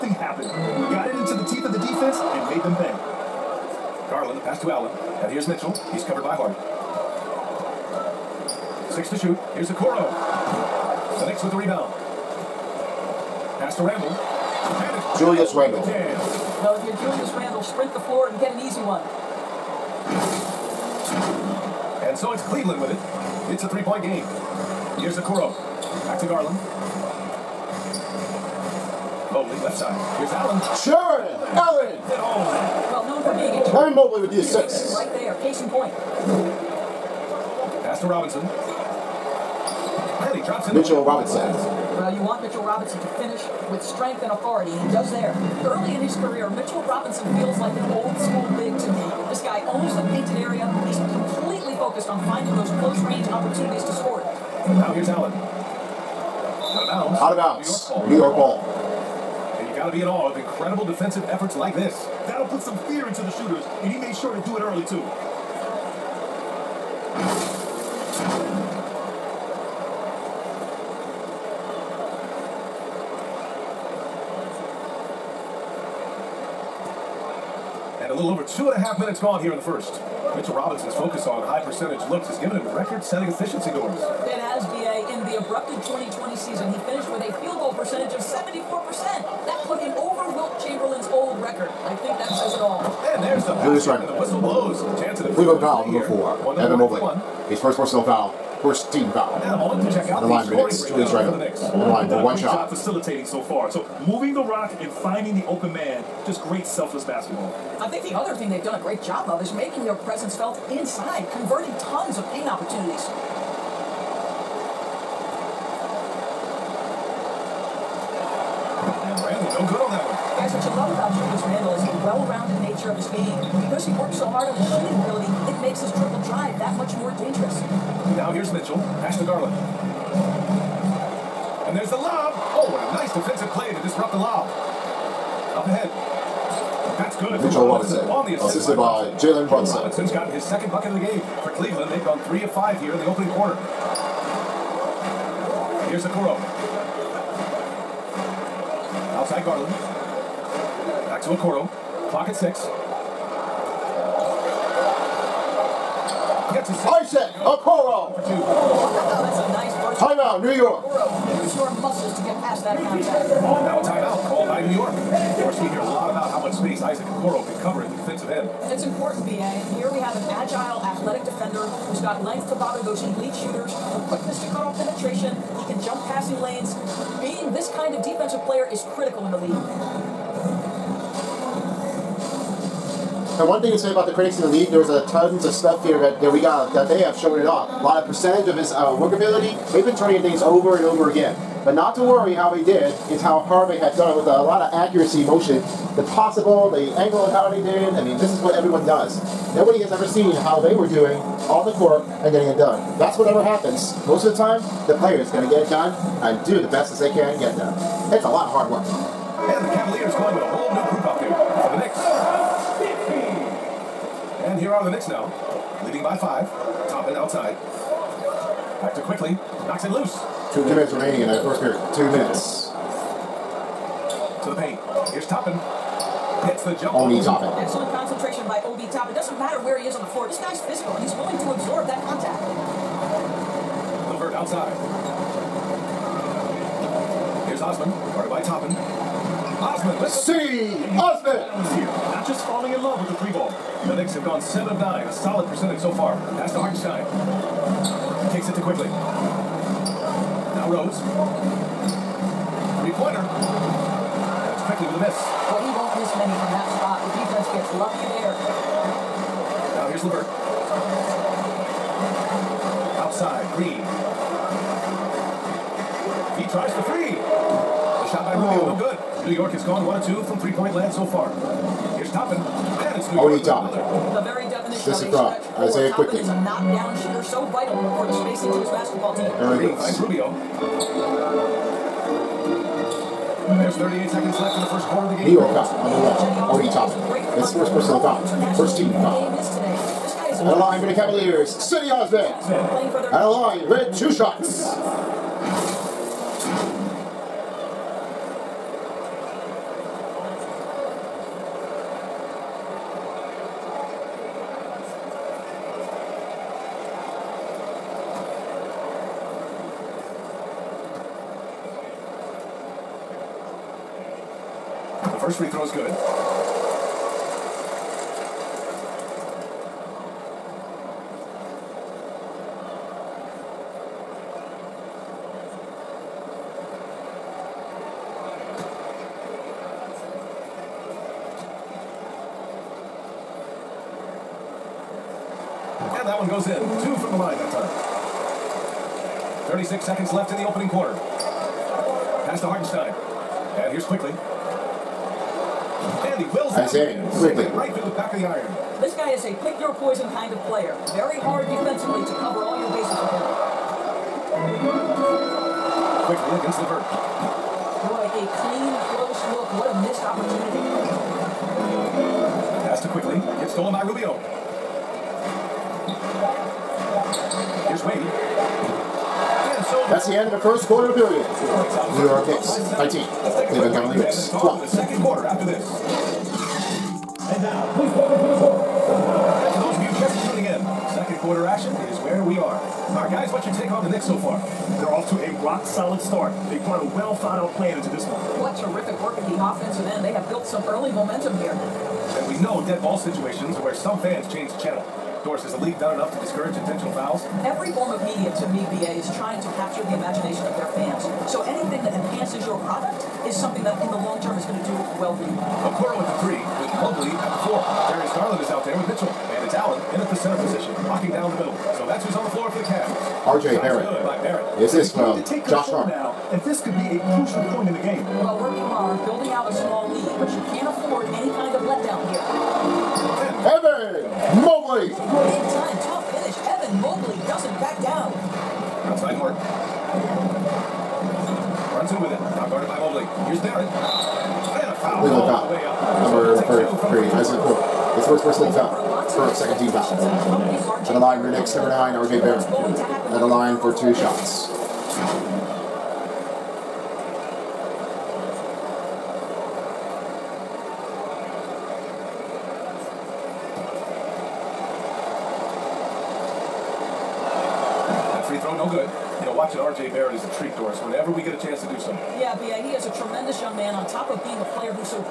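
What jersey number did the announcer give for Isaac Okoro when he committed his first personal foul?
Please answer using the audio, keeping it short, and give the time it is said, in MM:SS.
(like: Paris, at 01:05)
33, at 07:16.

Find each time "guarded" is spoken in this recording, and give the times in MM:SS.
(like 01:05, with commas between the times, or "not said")
03:58, 07:12.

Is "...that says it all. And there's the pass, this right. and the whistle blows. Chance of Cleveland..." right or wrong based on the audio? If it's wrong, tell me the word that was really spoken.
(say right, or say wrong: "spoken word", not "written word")
right.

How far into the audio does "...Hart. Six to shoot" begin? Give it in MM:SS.
00:06.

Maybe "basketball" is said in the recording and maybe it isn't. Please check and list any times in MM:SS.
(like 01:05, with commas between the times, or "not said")
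01:47, 04:38.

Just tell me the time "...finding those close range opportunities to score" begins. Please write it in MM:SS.
00:52.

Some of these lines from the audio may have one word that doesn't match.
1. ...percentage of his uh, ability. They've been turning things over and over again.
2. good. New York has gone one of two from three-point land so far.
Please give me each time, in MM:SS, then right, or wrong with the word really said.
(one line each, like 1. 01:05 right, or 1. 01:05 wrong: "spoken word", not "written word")
1. 03:08 wrong: "workability", not "ability"
2. 04:29 right.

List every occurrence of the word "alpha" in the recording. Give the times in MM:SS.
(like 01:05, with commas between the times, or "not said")
not said.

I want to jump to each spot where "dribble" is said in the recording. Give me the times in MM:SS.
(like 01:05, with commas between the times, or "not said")
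02:05.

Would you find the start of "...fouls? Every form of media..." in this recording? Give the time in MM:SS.
06:36.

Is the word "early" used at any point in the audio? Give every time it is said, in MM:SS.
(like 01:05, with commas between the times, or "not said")
00:45, 01:04, 06:30.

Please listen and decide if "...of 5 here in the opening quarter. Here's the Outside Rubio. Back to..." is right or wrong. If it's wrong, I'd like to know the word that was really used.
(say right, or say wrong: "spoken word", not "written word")
wrong: "Garland", not "Rubio".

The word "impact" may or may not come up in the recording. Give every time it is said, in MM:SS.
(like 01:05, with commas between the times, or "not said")
not said.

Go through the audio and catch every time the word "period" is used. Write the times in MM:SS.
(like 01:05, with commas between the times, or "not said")
03:41, 06:10.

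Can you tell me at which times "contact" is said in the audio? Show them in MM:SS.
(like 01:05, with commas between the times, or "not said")
02:42, 03:52.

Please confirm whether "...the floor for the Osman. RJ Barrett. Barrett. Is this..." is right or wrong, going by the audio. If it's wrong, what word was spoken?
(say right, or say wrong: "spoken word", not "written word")
wrong: "Cavs", not "Osman".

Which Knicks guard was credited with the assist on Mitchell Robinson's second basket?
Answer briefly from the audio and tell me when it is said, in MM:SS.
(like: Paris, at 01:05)
Jalen Brunson, at 02:19.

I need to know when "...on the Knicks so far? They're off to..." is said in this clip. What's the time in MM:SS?
06:23.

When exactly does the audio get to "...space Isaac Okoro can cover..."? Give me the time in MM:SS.
02:46.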